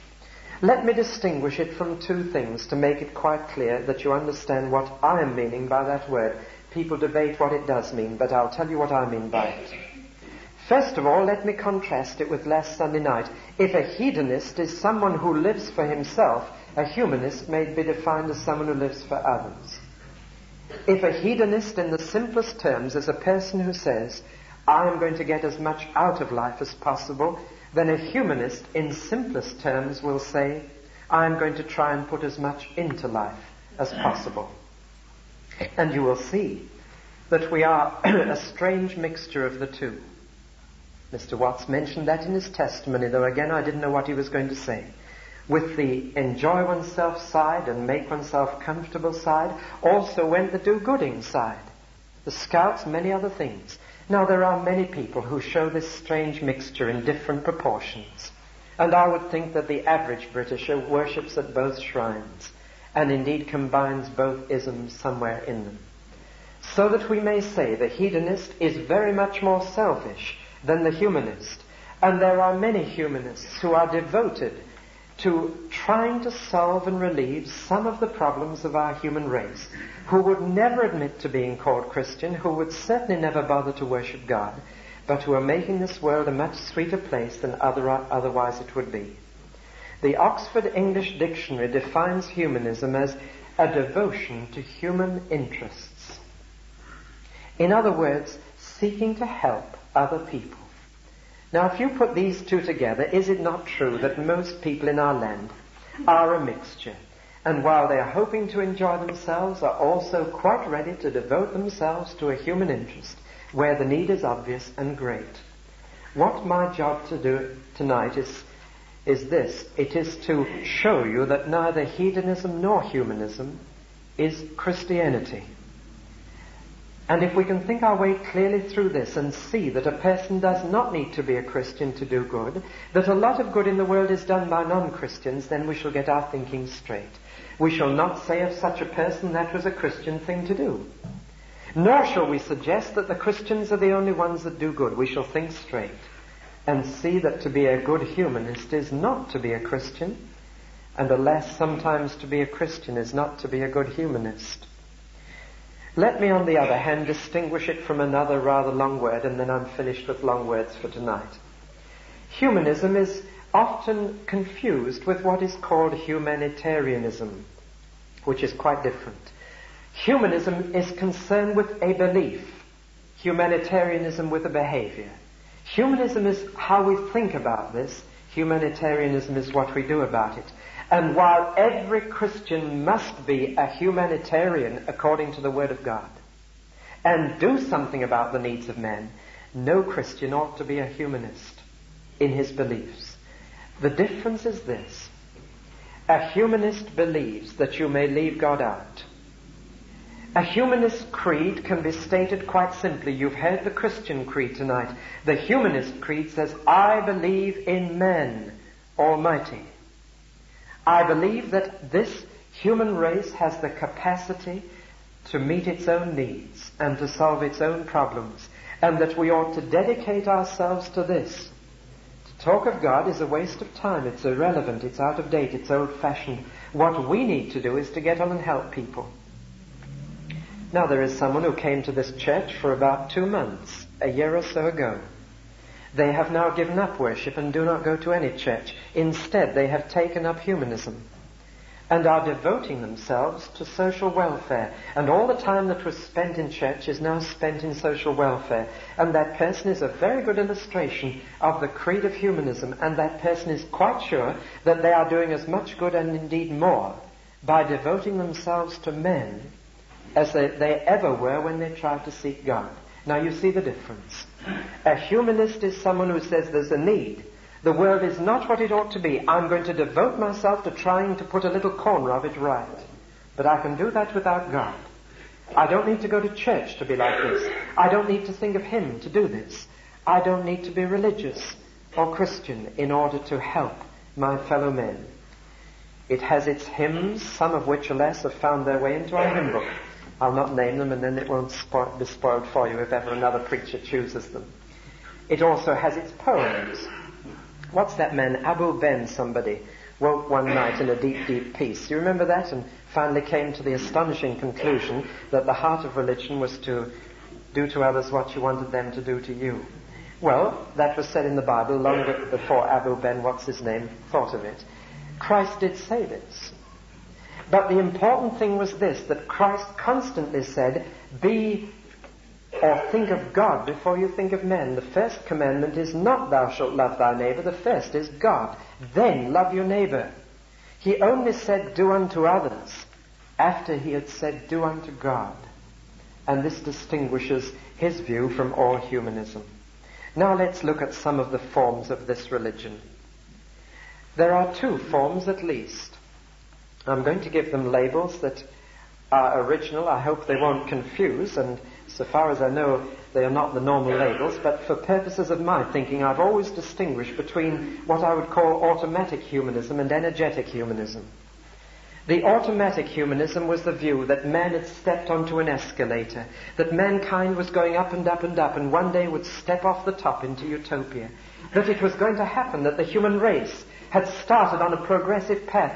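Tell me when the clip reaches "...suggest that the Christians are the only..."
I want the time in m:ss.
2:22.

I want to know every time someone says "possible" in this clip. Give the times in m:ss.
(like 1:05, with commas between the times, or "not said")
0:26, 0:33.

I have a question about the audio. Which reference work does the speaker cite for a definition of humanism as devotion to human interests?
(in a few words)
Oxford English Dictionary.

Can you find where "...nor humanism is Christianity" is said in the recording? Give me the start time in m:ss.
2:02.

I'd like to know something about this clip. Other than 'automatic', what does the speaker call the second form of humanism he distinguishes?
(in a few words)
energetic humanism.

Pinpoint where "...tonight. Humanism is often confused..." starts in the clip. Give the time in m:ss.
2:40.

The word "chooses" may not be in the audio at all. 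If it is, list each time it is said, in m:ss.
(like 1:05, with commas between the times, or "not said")
4:53.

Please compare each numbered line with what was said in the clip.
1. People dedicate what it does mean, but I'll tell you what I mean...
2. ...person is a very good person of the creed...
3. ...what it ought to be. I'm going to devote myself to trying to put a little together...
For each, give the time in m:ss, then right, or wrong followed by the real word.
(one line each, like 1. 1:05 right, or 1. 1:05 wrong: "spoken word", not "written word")
1. 0:06 wrong: "debate", not "dedicate"
2. 4:09 wrong: "illustration", not "person"
3. 4:28 wrong: "corner", not "together".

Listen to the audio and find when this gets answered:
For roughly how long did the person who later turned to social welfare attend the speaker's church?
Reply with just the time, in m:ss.
3:52.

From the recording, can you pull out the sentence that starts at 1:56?
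What my job to do tonight is, is this.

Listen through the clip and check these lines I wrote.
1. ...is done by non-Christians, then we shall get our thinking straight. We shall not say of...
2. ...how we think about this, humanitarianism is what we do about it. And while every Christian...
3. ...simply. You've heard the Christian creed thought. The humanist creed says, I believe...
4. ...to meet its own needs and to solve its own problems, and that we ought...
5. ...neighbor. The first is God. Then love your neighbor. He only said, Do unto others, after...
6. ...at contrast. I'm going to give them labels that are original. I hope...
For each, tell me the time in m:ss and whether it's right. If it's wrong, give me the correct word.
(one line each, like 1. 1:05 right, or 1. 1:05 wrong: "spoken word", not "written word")
1. 2:14 right
2. 2:56 right
3. 3:22 wrong: "tonight", not "thought"
4. 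3:35 right
5. 5:27 right
6. 5:45 wrong: "least", not "contrast".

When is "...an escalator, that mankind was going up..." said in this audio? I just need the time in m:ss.
6:05.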